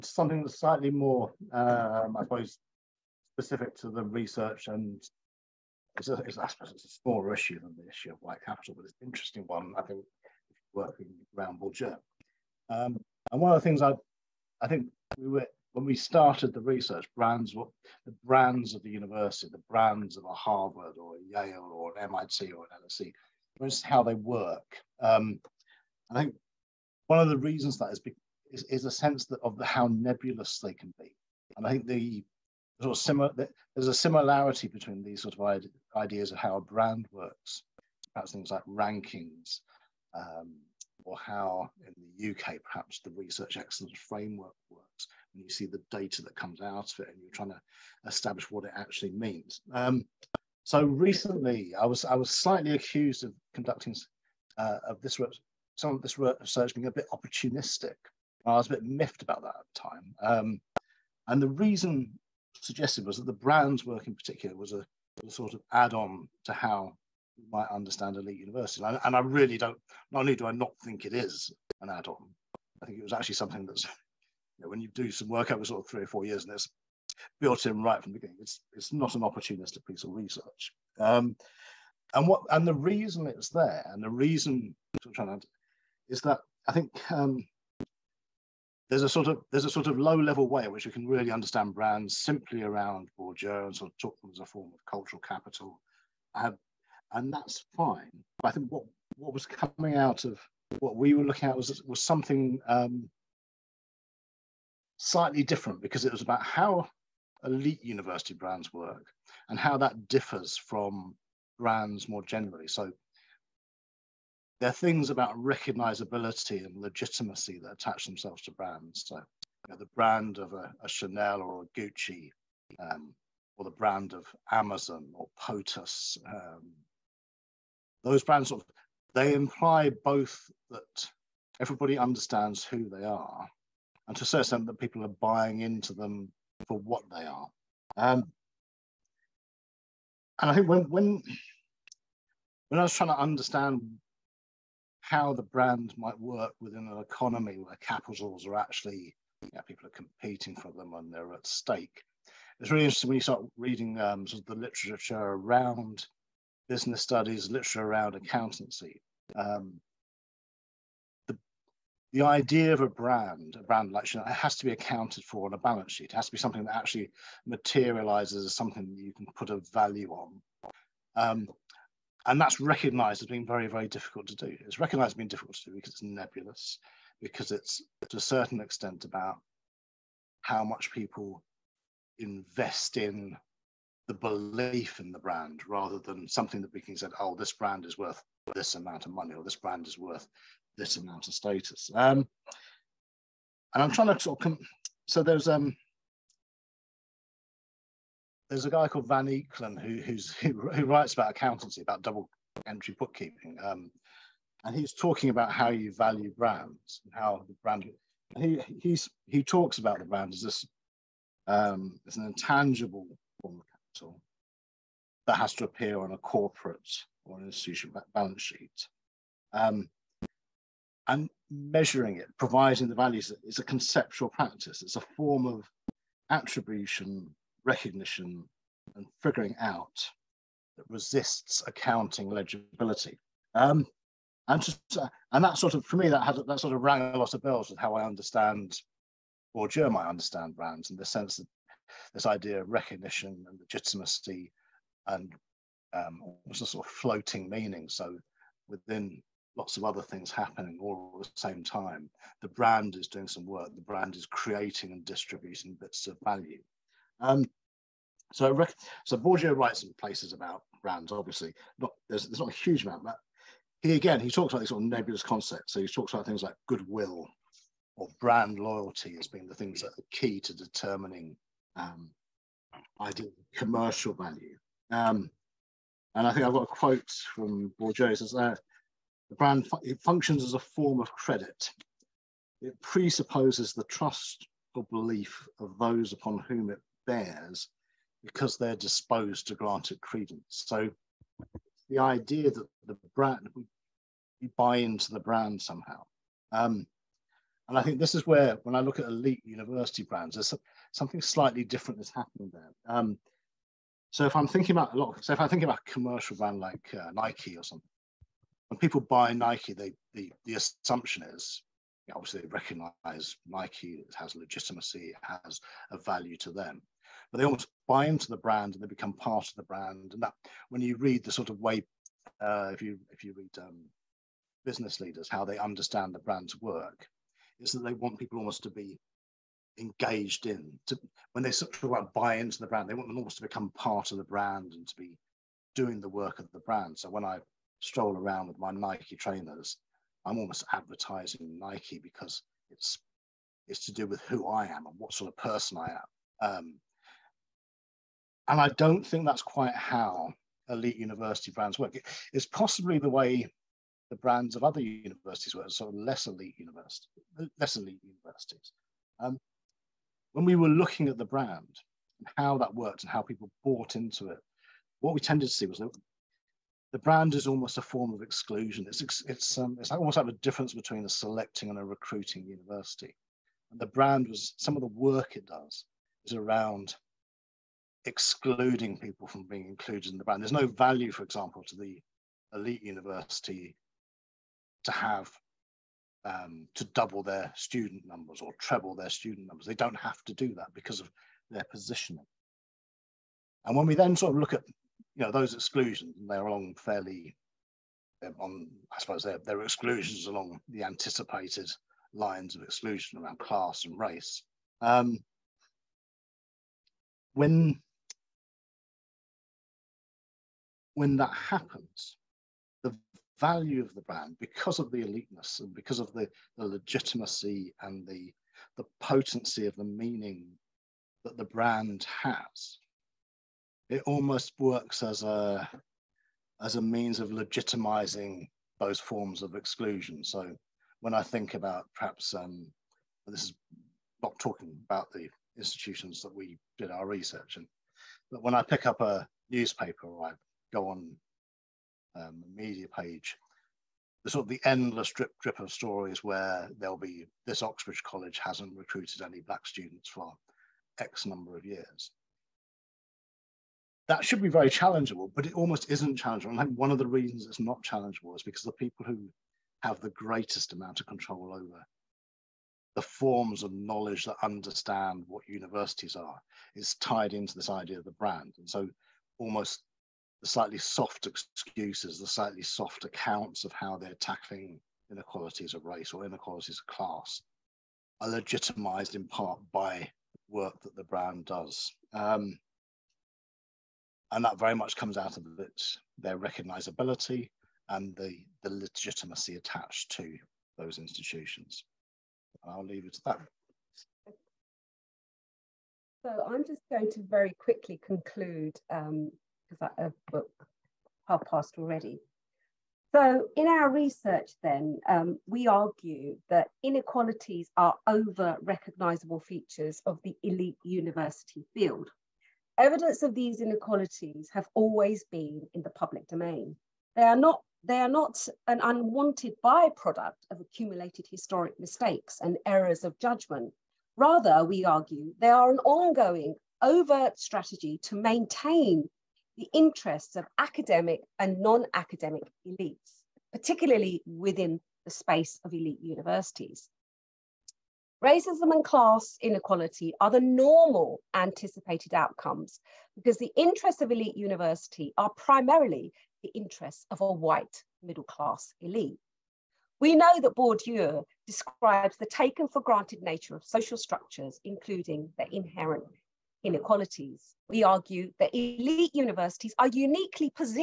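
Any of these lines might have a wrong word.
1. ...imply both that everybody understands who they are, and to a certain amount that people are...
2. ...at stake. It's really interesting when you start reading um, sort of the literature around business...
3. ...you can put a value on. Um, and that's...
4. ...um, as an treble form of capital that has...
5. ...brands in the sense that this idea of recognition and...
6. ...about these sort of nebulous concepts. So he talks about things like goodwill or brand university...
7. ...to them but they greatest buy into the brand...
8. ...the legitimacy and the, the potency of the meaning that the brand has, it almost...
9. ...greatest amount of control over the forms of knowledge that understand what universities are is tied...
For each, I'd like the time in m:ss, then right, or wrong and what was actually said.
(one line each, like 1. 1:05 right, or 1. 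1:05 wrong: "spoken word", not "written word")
1. 2:09 wrong: "extent", not "amount"
2. 2:31 right
3. 2:49 right
4. 3:31 wrong: "intangible", not "treble"
5. 4:00 right
6. 4:24 wrong: "loyalty", not "university"
7. 5:16 wrong: "almost", not "greatest"
8. 6:56 right
9. 7:40 right.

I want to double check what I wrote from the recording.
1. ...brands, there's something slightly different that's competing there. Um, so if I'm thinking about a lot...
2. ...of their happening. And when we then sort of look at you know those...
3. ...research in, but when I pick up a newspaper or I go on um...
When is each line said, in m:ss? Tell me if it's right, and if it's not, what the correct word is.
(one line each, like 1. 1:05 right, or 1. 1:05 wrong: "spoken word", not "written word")
1. 5:00 wrong: "happening", not "competing"
2. 6:31 wrong: "positioning", not "happening"
3. 7:17 right.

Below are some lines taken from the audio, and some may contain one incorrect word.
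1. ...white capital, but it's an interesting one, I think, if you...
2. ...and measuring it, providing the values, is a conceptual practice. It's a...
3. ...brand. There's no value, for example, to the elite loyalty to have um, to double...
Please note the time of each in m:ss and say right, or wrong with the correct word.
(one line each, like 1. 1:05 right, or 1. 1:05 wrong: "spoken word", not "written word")
1. 0:08 right
2. 3:41 right
3. 6:20 wrong: "university", not "loyalty".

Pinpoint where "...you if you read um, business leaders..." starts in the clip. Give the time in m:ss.
5:22.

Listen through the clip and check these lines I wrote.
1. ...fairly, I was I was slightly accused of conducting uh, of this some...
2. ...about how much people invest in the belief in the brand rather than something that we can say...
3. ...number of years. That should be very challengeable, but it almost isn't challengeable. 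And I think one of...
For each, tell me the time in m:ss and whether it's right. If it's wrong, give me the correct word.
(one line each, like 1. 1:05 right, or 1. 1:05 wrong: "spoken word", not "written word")
1. 0:50 wrong: "recently", not "fairly"
2. 2:59 right
3. 7:31 right.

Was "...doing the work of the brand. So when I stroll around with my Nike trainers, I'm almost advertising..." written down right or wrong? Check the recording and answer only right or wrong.
right.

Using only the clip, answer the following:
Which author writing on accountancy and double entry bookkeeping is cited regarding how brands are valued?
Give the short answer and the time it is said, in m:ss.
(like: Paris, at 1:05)
Van Eeklen, at 3:19.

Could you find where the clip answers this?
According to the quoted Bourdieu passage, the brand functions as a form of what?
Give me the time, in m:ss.
4:41.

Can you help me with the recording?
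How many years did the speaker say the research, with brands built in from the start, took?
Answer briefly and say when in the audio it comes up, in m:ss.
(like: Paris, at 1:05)
3 or 4 years, at 1:15.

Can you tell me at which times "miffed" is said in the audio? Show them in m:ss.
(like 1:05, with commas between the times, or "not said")
0:58.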